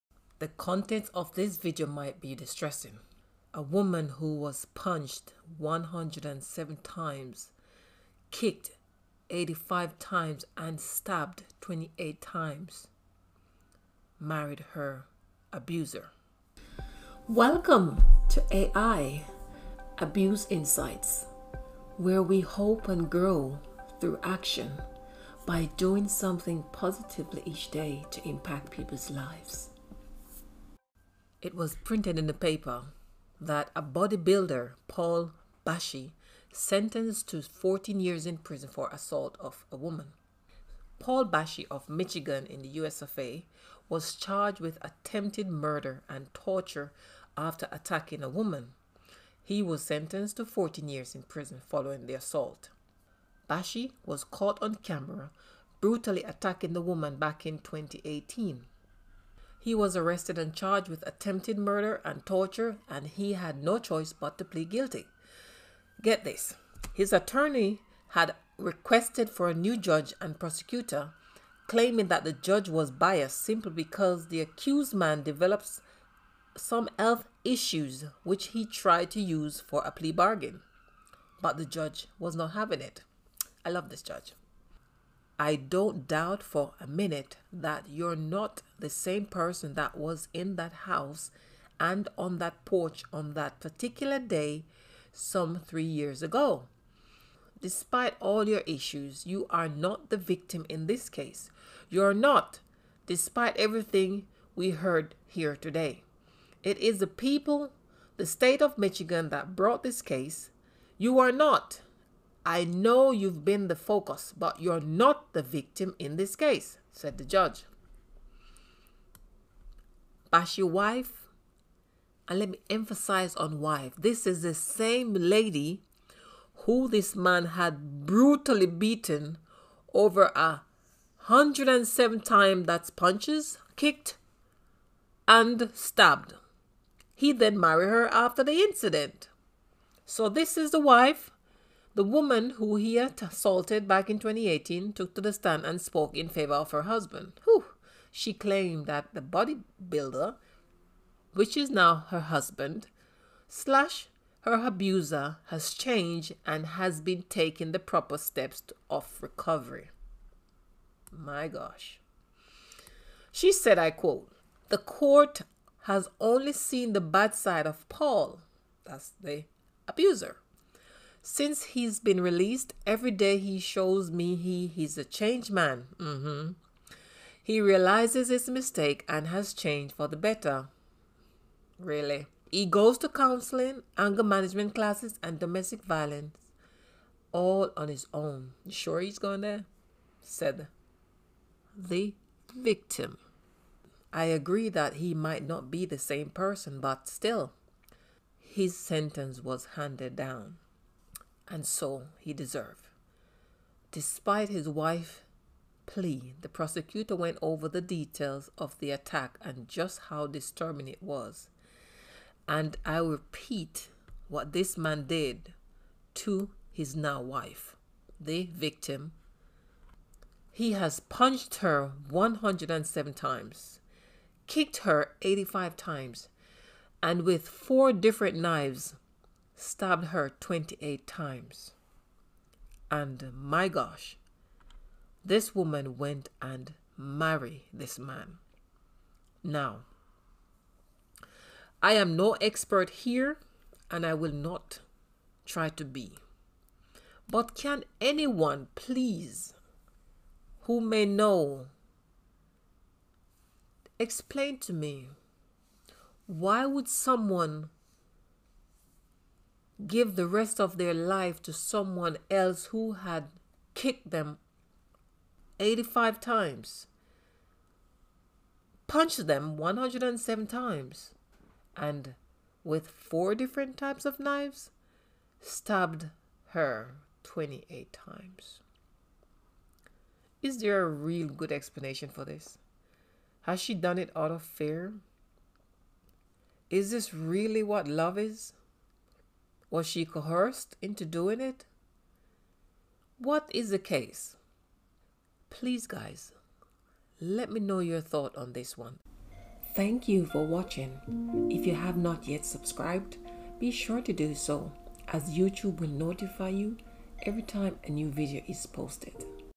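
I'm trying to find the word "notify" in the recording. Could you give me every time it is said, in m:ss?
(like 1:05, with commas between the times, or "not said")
5:05.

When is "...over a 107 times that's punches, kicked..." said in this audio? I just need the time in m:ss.
2:09.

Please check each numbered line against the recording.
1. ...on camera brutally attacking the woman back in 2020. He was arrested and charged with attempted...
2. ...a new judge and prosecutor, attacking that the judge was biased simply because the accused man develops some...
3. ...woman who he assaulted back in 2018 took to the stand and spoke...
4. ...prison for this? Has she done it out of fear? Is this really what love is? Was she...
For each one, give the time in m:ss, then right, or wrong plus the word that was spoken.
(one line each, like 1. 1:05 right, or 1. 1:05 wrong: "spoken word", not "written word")
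1. 0:54 wrong: "2018", not "2020"
2. 1:09 wrong: "claiming", not "attacking"
3. 2:22 right
4. 4:41 wrong: "explanation", not "prison".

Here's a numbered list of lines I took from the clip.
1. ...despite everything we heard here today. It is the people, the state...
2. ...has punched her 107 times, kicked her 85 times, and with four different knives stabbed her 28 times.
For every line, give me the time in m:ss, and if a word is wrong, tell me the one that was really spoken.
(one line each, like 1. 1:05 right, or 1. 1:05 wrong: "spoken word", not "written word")
1. 1:43 right
2. 3:40 right.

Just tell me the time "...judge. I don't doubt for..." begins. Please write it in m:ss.
1:24.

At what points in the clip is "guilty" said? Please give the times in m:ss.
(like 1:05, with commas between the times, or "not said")
1:04.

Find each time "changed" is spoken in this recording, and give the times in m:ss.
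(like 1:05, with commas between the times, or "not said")
2:35, 2:55, 2:59.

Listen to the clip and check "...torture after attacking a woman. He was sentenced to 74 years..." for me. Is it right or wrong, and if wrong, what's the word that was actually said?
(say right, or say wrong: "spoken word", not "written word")
wrong: "14", not "74".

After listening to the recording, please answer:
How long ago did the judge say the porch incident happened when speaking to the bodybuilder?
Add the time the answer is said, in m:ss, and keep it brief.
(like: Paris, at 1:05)
3 years ago, at 1:35.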